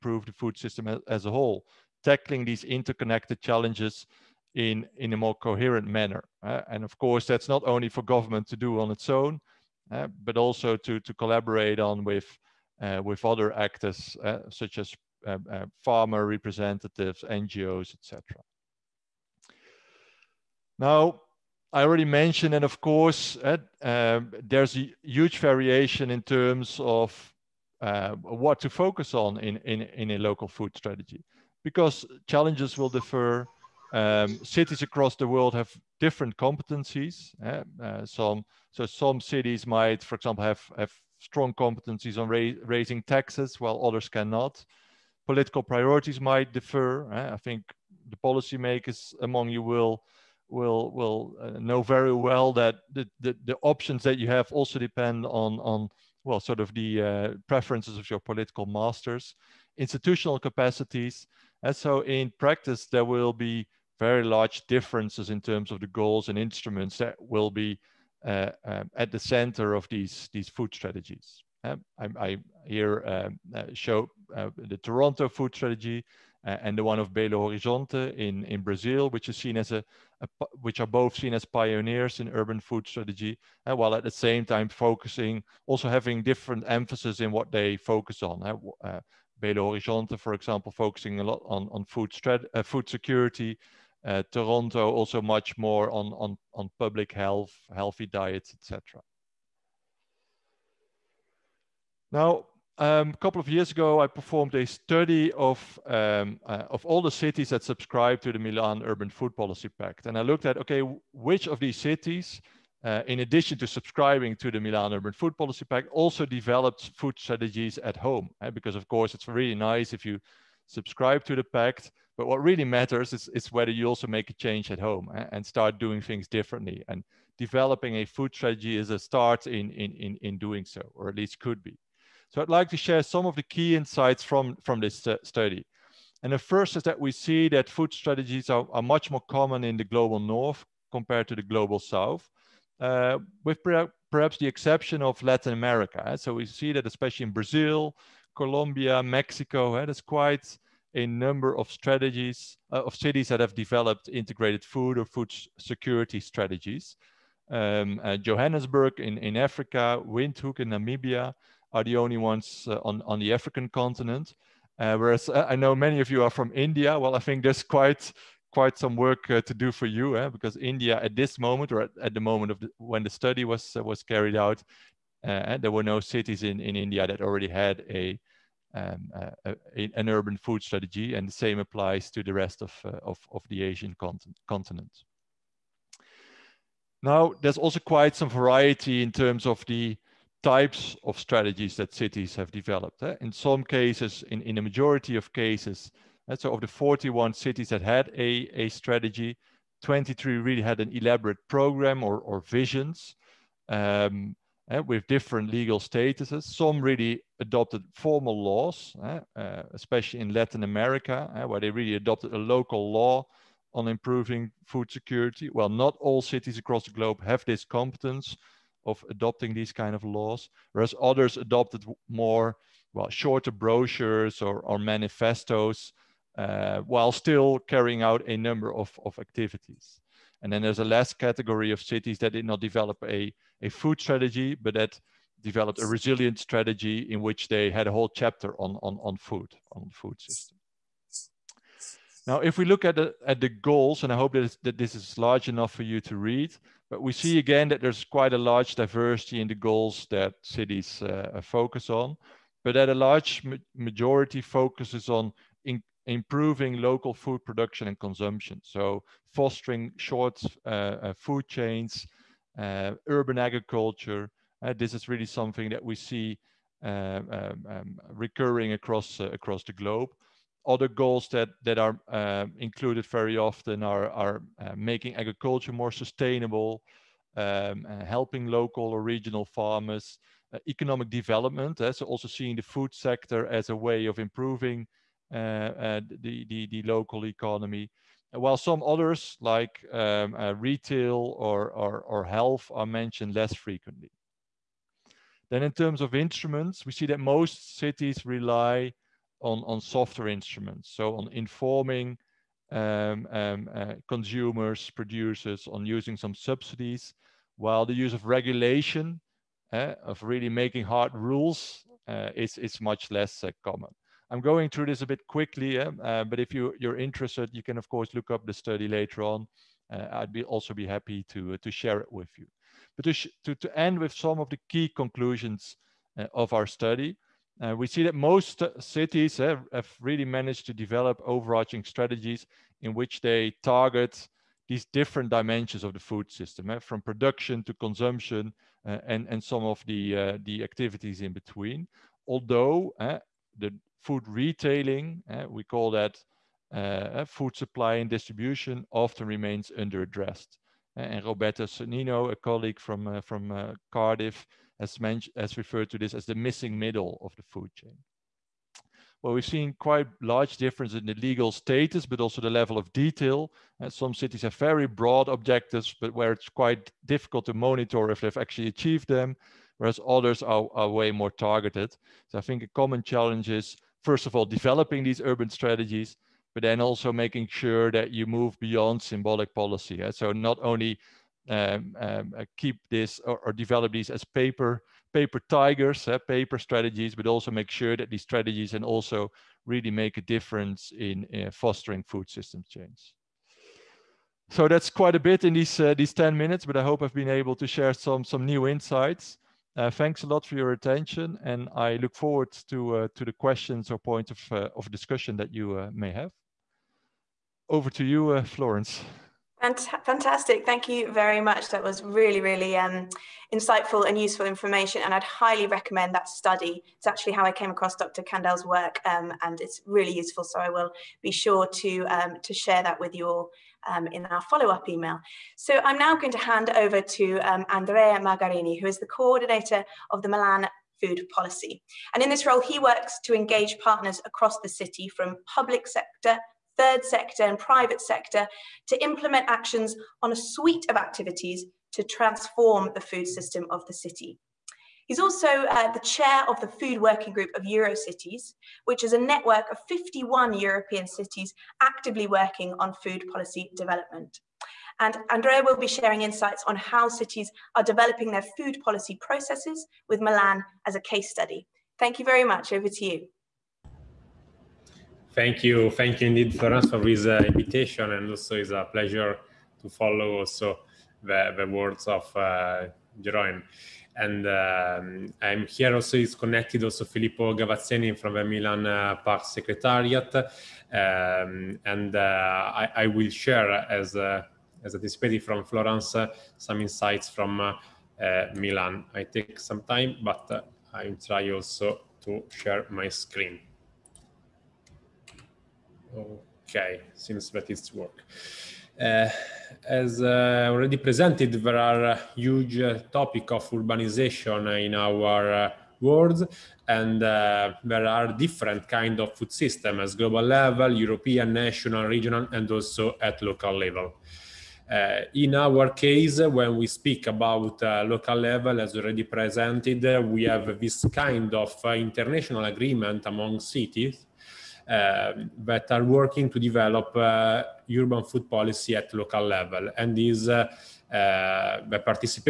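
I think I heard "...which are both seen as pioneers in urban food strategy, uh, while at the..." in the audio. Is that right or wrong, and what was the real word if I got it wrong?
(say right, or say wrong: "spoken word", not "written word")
right.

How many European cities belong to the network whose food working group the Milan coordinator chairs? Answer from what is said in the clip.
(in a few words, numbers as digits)
51.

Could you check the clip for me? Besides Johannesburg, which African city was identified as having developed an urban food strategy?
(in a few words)
Windhoek.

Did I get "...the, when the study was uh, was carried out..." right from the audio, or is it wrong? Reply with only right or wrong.
right.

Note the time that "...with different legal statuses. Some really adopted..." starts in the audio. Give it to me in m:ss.
3:24.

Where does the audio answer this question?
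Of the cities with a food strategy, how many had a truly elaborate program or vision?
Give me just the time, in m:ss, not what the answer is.
3:19.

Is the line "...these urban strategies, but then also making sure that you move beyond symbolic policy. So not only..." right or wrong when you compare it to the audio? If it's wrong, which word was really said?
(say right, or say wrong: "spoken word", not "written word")
right.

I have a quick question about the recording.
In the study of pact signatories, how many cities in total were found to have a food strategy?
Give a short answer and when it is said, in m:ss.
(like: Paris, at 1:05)
41, at 3:16.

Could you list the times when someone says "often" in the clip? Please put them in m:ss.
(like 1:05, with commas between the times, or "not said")
4:33, 5:48.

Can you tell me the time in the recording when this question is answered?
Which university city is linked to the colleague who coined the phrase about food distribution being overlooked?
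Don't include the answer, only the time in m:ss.
5:53.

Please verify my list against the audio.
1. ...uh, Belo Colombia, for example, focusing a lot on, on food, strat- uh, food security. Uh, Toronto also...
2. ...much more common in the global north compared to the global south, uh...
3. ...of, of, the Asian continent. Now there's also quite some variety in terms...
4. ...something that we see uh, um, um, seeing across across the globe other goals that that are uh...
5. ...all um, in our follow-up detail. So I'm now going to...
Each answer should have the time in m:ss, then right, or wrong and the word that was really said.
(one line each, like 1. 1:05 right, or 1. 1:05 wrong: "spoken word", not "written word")
1. 1:28 wrong: "Horizonte", not "Colombia"
2. 2:18 right
3. 3:03 right
4. 4:25 wrong: "recurring", not "seeing"
5. 7:03 wrong: "email", not "detail".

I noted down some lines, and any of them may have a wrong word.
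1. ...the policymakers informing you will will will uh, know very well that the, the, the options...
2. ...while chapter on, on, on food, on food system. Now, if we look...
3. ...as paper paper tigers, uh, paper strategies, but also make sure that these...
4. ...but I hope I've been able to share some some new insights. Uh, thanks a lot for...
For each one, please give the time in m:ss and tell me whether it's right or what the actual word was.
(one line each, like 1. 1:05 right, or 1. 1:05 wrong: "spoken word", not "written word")
1. 0:48 wrong: "among", not "informing"
2. 3:57 wrong: "whole", not "while"
3. 6:24 right
4. 6:36 right.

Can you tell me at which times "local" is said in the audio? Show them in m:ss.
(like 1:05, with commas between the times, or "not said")
0:30, 3:32, 4:16, 4:38, 4:46, 8:33, 8:38, 8:49.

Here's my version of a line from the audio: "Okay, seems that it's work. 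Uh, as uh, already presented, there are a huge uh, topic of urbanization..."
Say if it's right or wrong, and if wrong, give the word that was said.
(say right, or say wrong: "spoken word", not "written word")
right.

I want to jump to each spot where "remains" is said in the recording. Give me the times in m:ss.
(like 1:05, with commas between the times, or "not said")
5:49.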